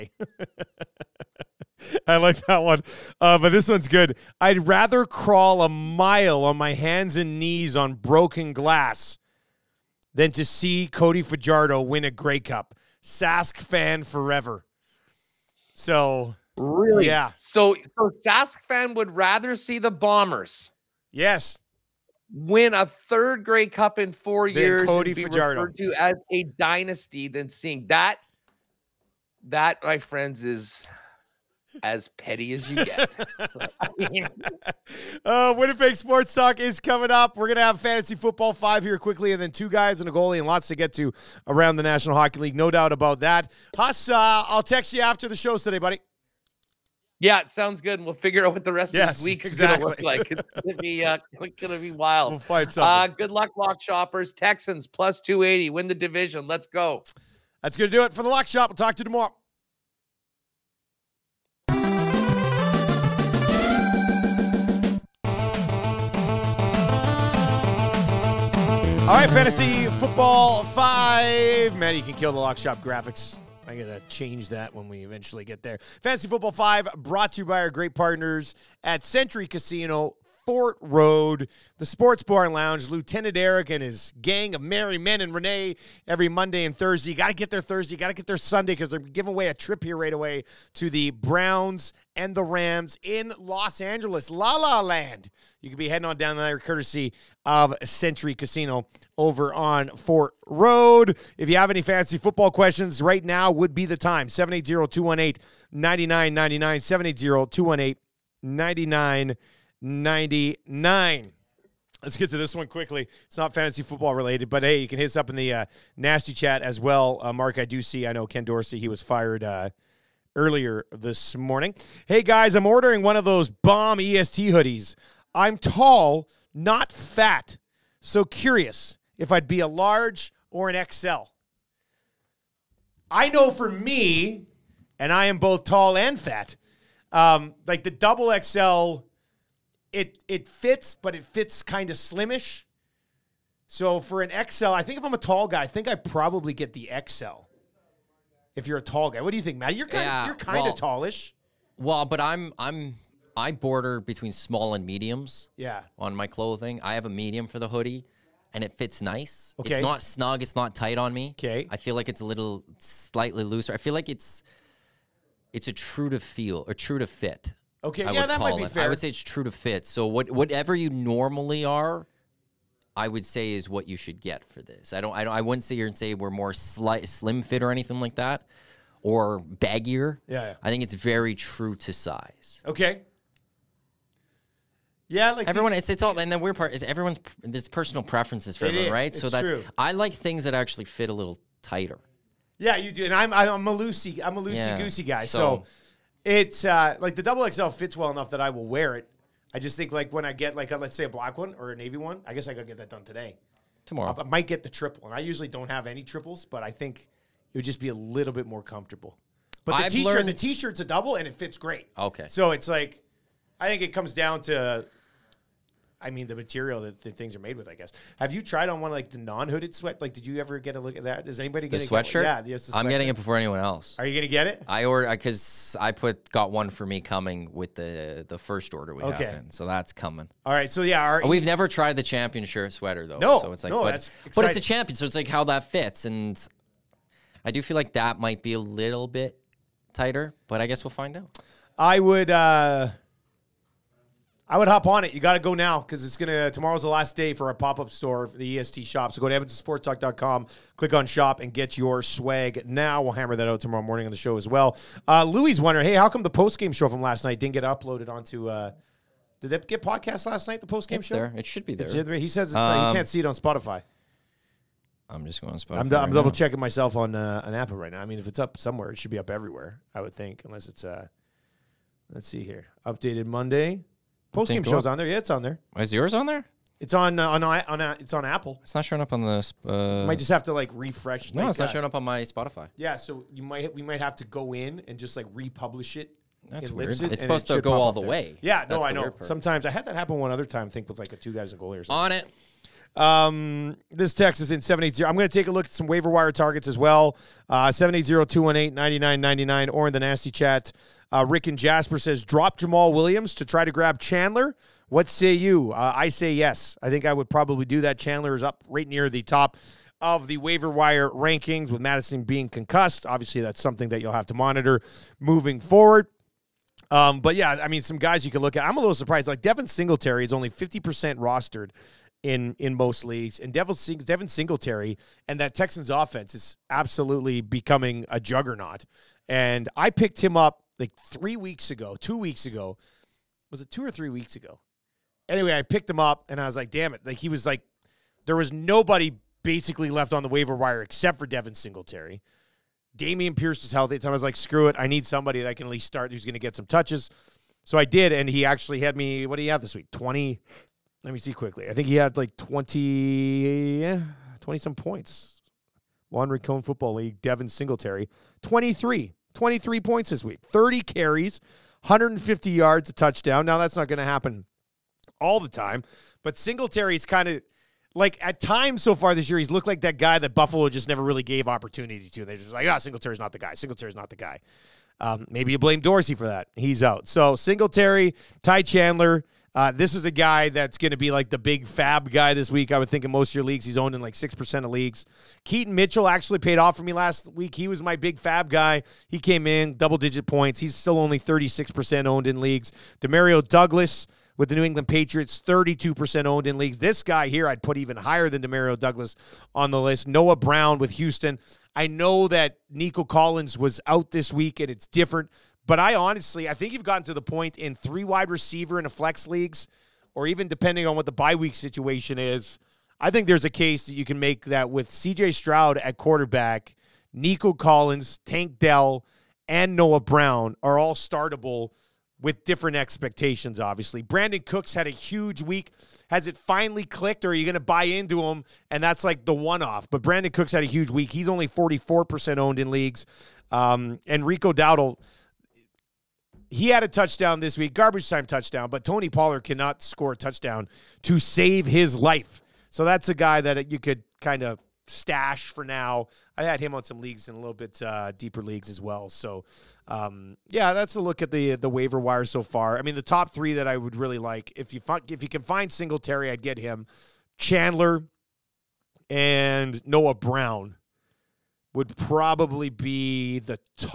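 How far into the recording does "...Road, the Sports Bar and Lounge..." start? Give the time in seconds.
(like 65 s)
80 s.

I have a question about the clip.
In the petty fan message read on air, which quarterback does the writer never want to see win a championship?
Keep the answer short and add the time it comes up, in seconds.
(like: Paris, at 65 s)
Cody Fajardo, at 10 s.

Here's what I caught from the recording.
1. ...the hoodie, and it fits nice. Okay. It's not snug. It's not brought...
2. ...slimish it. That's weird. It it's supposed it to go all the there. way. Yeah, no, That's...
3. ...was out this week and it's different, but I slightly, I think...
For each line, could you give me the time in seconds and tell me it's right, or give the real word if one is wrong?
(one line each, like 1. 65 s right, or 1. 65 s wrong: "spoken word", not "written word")
1. 157 s wrong: "tight", not "brought"
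2. 285 s wrong: "republish", not "slimish"
3. 403 s wrong: "honestly", not "slightly".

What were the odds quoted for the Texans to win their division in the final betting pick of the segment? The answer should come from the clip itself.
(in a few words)
plus 280.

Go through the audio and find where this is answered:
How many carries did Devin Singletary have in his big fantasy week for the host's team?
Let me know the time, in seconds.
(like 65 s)
360 s.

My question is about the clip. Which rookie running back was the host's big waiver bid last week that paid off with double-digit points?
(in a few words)
Keaton Mitchell.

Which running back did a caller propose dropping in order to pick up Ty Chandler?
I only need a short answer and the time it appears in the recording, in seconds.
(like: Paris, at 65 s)
Jamaal Williams, at 302 s.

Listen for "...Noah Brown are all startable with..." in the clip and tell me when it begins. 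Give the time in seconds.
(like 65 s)
419 s.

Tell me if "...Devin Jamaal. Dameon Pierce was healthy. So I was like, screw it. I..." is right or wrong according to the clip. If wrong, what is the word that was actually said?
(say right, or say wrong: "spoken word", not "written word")
wrong: "Singletary", not "Jamaal".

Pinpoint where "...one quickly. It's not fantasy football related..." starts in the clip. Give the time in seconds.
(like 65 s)
112 s.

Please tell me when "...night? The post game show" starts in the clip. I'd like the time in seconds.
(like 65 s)
260 s.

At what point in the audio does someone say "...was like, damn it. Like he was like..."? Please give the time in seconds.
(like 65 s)
336 s.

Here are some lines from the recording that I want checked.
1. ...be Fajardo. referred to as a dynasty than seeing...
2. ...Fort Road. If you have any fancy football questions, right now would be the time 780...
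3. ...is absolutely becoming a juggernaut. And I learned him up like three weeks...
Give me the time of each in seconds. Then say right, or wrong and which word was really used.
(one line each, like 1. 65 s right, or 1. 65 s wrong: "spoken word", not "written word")
1. 25 s right
2. 99 s right
3. 326 s wrong: "picked", not "learned".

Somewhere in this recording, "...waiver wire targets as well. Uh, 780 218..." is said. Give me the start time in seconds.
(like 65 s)
295 s.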